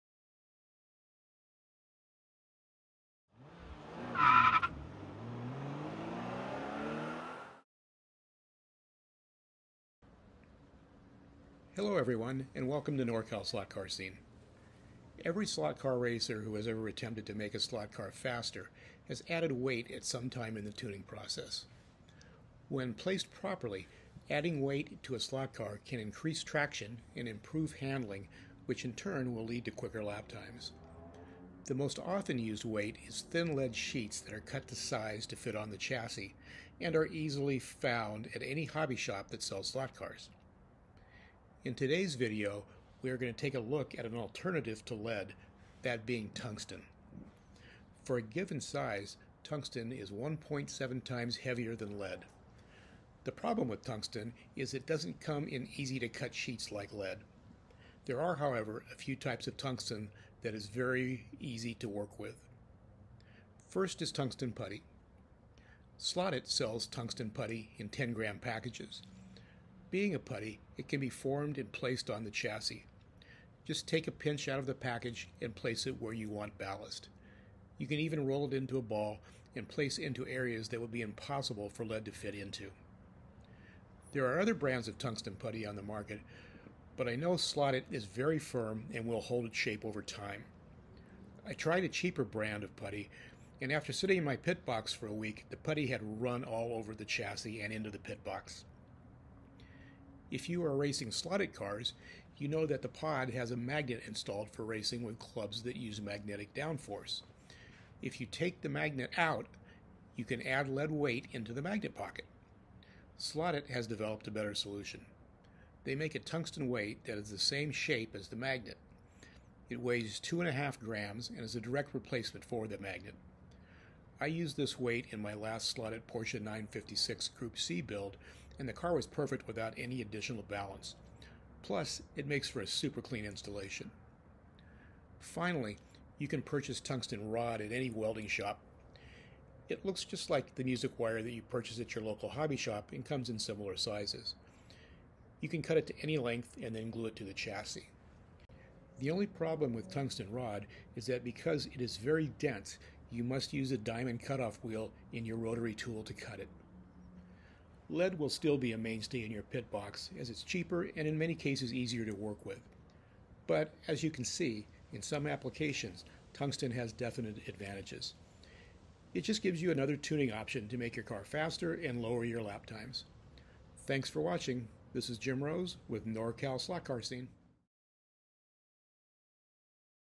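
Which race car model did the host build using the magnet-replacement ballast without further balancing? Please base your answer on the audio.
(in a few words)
Porsche 956.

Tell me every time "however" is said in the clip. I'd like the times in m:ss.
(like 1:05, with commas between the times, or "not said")
0:58.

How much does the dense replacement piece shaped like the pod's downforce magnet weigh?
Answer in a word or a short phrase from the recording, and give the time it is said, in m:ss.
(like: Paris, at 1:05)
2.5 grams, at 2:00.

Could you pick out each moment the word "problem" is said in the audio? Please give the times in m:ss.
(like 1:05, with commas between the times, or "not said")
0:53, 2:29.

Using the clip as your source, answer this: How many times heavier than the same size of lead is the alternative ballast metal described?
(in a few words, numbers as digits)
1.7.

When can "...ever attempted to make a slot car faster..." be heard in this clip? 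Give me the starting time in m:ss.
0:16.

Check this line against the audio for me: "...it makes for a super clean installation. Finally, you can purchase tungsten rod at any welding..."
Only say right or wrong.
right.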